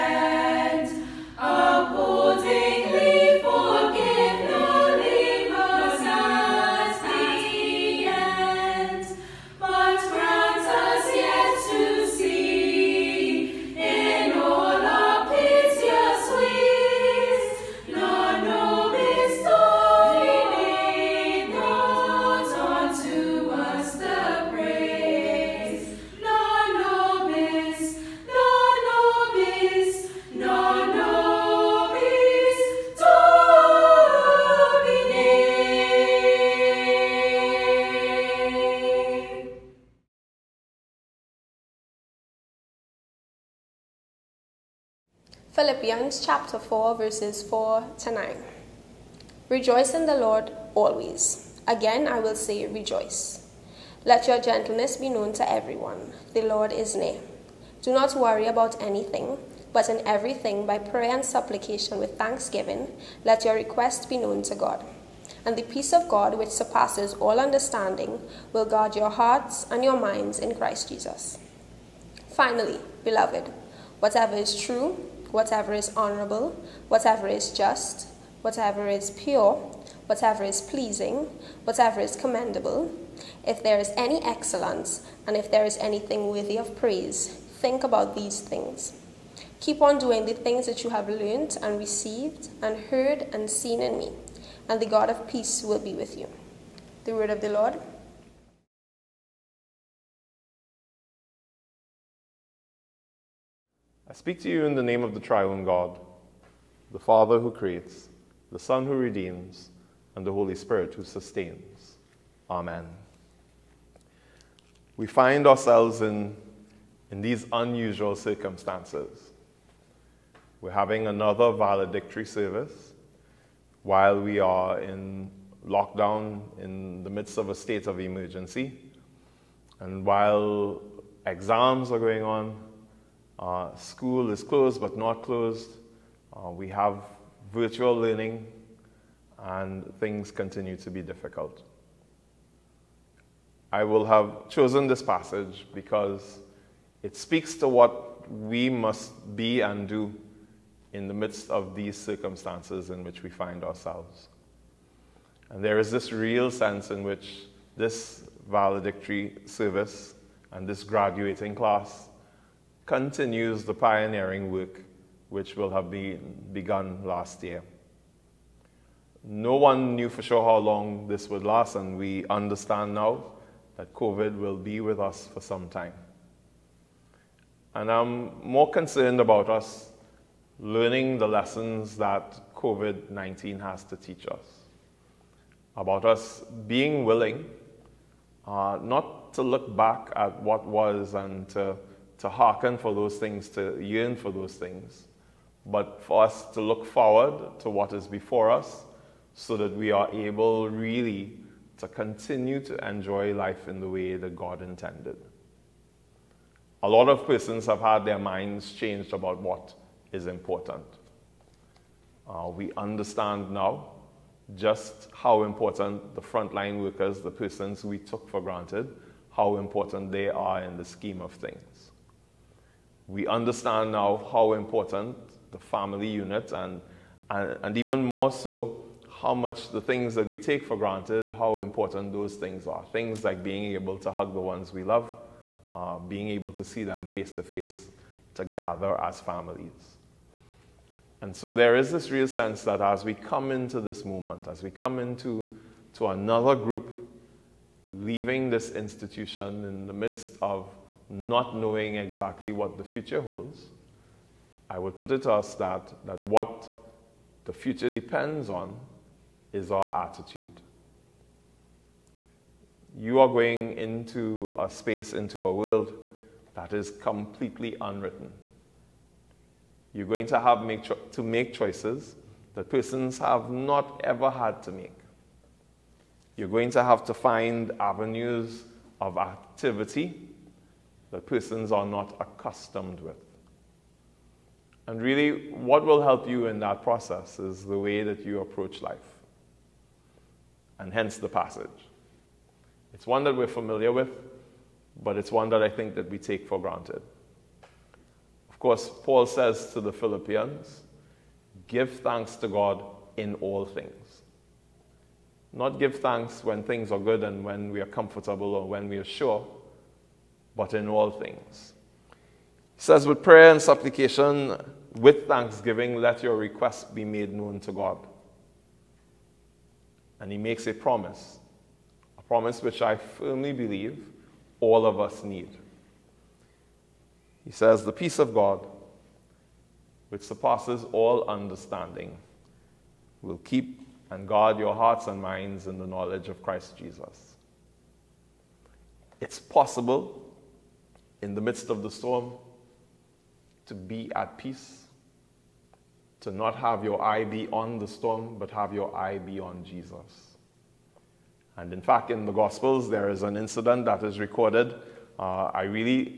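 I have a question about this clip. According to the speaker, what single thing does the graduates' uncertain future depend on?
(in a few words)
Attitude.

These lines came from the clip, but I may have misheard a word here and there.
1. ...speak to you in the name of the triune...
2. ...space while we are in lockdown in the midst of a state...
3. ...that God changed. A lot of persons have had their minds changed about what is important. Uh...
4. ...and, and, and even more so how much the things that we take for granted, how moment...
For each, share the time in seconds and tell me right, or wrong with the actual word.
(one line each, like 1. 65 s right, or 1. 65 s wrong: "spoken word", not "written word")
1. 104 s right
2. 122 s wrong: "service", not "space"
3. 204 s wrong: "intended", not "changed"
4. 226 s wrong: "important", not "moment".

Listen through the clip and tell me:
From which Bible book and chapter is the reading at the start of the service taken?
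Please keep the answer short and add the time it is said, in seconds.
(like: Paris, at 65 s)
Philippians 4, at 45 s.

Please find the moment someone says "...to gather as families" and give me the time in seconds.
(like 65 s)
238 s.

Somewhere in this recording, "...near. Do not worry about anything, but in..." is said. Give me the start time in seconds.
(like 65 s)
56 s.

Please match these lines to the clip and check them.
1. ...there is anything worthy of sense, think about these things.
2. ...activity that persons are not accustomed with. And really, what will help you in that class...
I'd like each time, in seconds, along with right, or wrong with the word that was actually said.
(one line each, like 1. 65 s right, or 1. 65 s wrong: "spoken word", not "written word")
1. 85 s wrong: "praise", not "sense"
2. 279 s wrong: "process", not "class".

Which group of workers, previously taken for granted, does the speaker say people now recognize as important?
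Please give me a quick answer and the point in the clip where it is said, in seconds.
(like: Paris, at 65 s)
Frontline workers, at 216 s.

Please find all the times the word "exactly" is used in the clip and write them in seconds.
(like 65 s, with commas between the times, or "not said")
251 s.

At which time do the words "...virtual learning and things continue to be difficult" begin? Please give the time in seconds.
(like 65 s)
137 s.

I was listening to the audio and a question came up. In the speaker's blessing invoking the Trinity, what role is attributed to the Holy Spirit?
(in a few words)
Sustains.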